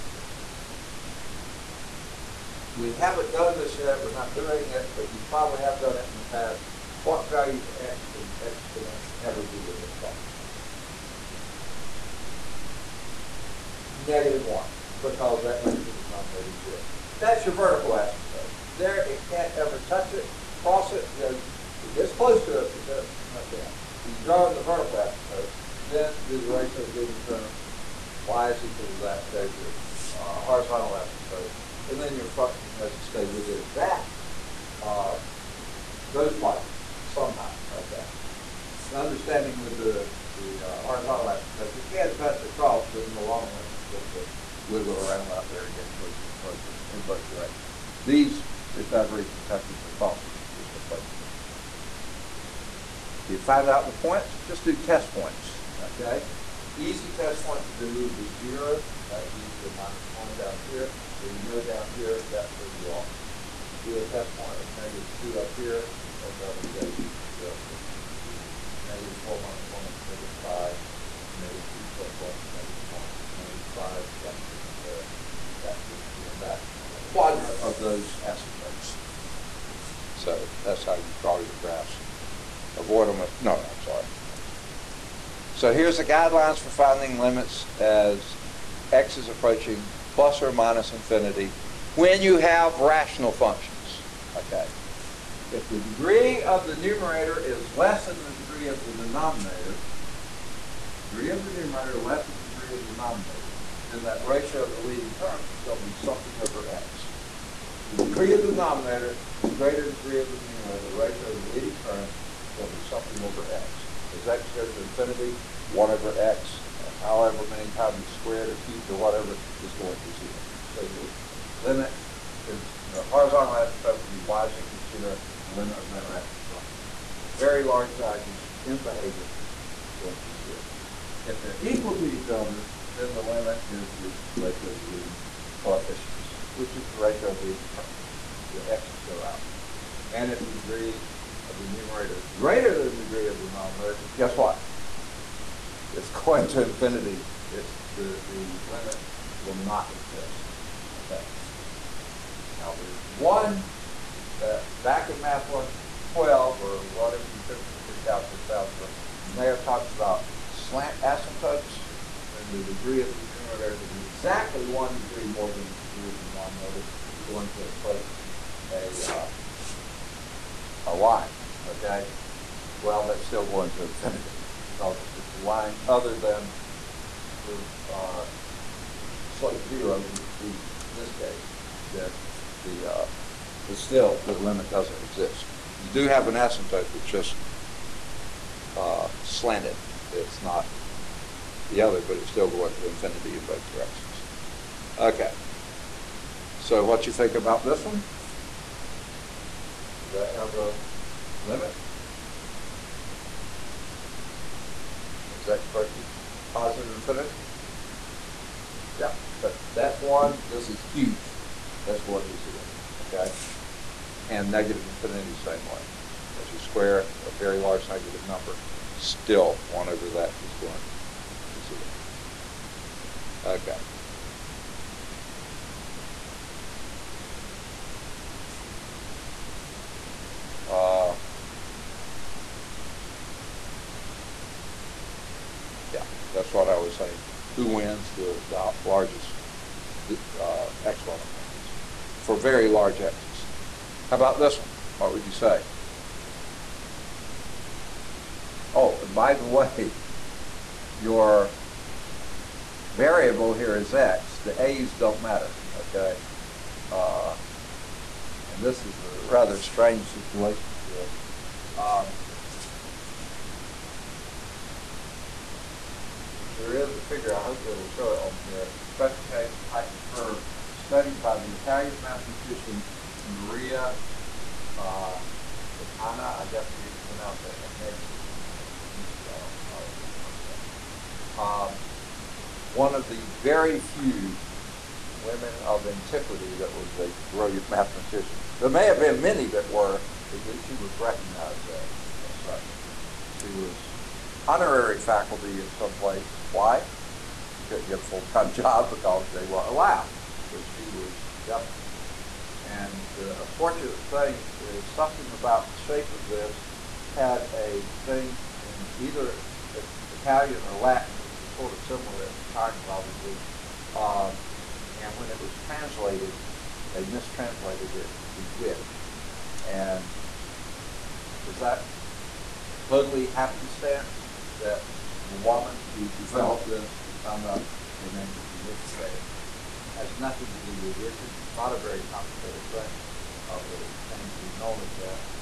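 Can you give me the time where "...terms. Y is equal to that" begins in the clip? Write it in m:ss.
0:27.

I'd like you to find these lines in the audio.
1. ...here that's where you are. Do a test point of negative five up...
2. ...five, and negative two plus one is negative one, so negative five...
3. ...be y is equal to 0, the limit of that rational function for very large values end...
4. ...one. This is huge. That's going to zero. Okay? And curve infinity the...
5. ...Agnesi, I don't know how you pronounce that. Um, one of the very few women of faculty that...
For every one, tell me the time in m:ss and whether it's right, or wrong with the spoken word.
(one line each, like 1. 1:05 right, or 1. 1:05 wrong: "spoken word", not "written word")
1. 1:01 wrong: "two", not "five"
2. 1:10 right
3. 2:04 right
4. 3:30 wrong: "negative", not "curve"
5. 4:38 wrong: "antiquity", not "faculty".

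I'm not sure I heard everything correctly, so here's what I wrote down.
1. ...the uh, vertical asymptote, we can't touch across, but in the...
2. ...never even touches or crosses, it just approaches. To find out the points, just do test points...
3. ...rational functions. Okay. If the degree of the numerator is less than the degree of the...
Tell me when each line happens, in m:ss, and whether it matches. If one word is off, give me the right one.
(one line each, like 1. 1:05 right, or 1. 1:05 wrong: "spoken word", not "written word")
1. 0:40 wrong: "horizontal", not "vertical"
2. 0:48 right
3. 1:32 right.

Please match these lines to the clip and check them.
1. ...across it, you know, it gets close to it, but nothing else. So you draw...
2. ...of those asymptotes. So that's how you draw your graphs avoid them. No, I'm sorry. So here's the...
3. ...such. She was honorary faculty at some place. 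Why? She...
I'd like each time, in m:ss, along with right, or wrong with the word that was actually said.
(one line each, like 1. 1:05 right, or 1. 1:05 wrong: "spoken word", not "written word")
1. 0:20 wrong: "cross", not "across"
2. 1:17 right
3. 4:52 right.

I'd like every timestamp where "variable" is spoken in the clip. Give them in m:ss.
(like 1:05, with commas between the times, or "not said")
4:12.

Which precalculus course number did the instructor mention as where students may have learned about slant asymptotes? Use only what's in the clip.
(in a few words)
Math 112.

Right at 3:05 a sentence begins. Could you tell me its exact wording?
You do have an asymptote, it's just uh, slanted.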